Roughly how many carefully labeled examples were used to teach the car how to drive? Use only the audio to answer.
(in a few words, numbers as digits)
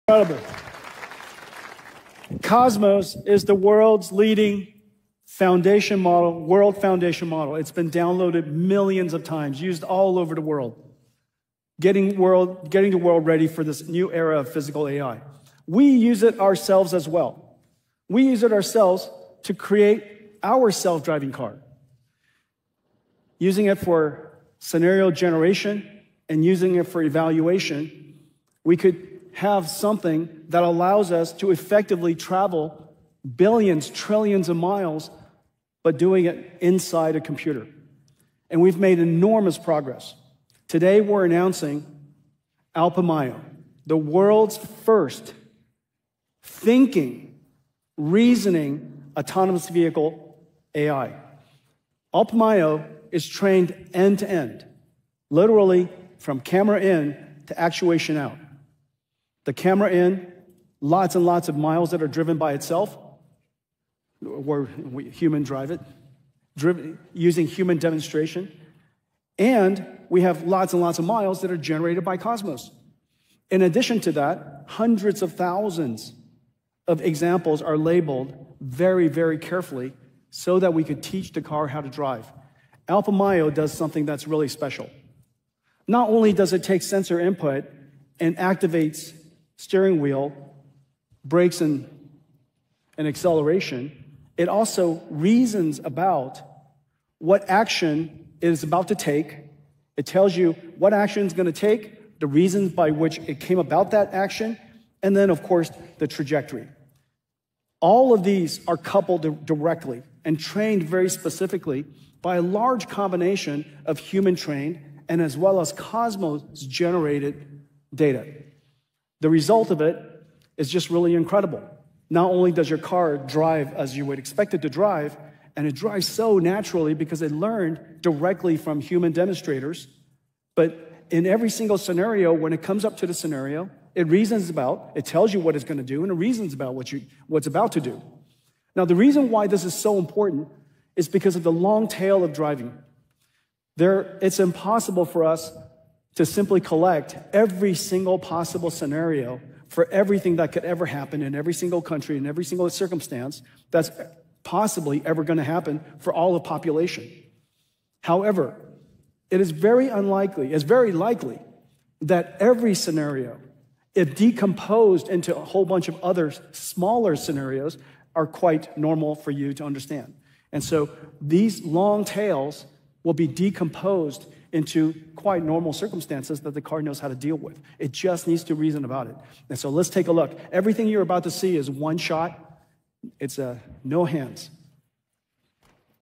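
hundreds of thousands.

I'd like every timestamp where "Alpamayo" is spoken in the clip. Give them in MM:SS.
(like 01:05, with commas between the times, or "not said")
00:42, 00:52, 01:22.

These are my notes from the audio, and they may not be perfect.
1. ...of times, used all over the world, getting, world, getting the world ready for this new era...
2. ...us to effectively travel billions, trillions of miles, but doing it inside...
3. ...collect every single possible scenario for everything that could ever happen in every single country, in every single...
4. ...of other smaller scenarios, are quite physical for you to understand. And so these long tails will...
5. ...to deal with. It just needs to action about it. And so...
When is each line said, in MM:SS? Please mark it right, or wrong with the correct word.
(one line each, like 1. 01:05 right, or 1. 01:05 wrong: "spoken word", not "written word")
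1. 00:09 right
2. 00:31 right
3. 02:26 right
4. 02:45 wrong: "normal", not "physical"
5. 02:57 wrong: "reason", not "action".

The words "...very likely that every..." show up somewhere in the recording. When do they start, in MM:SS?
02:40.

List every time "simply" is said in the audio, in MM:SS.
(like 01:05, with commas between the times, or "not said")
02:26.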